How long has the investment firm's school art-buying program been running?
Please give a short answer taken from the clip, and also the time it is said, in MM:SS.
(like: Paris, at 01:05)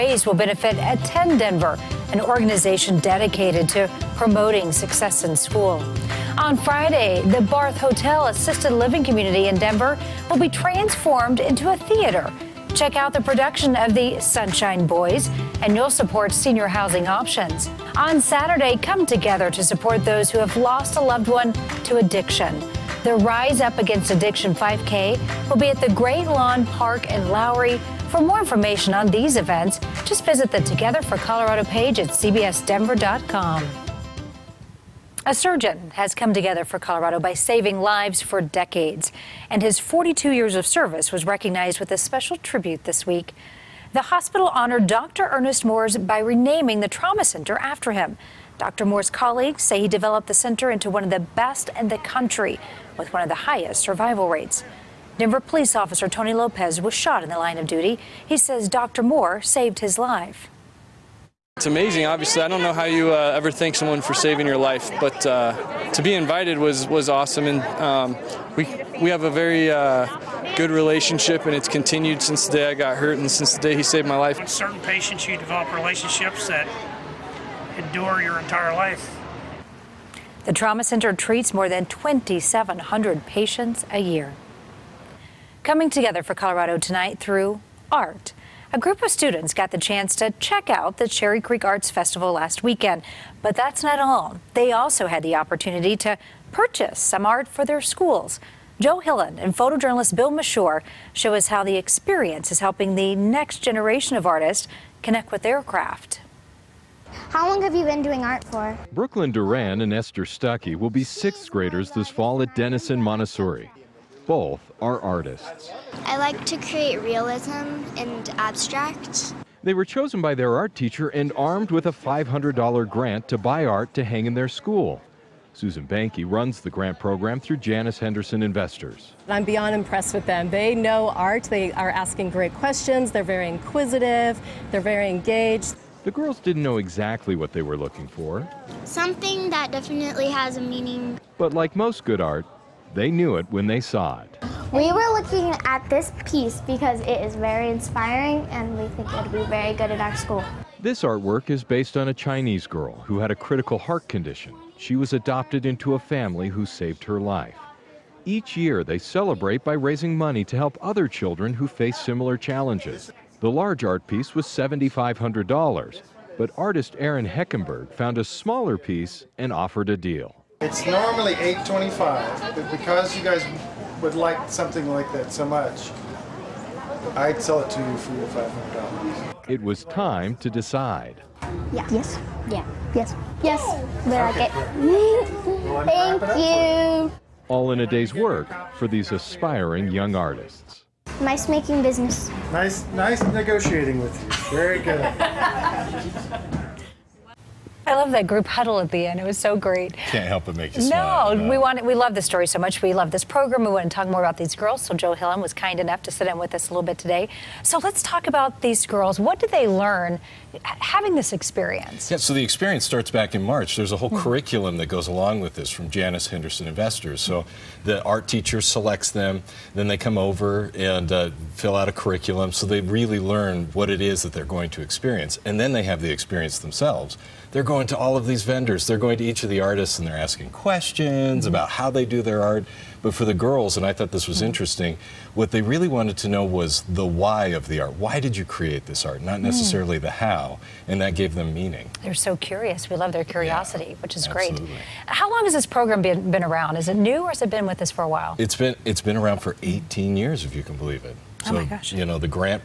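18 years, at 04:09.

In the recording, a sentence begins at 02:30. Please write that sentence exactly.
This artwork is based on a Chinese girl who had a critical heart condition.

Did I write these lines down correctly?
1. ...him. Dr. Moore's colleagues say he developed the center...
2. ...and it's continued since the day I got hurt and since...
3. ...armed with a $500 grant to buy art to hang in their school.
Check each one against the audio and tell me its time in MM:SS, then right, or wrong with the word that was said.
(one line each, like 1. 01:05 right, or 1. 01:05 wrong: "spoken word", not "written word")
1. 00:47 right
2. 01:11 right
3. 02:01 right.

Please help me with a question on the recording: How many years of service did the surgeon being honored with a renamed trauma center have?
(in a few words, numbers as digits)
42.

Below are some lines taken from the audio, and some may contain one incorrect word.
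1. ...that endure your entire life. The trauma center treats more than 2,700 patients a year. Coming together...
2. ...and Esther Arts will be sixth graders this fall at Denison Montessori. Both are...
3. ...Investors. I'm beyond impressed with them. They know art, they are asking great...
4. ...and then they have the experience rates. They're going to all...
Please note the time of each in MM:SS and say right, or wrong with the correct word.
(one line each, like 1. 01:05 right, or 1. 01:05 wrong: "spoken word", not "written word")
1. 01:16 right
2. 01:49 wrong: "Stuckey", not "Arts"
3. 02:08 right
4. 03:45 wrong: "themselves", not "rates".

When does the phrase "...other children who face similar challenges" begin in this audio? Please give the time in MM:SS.
02:40.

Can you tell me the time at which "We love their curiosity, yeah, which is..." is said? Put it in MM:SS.
04:02.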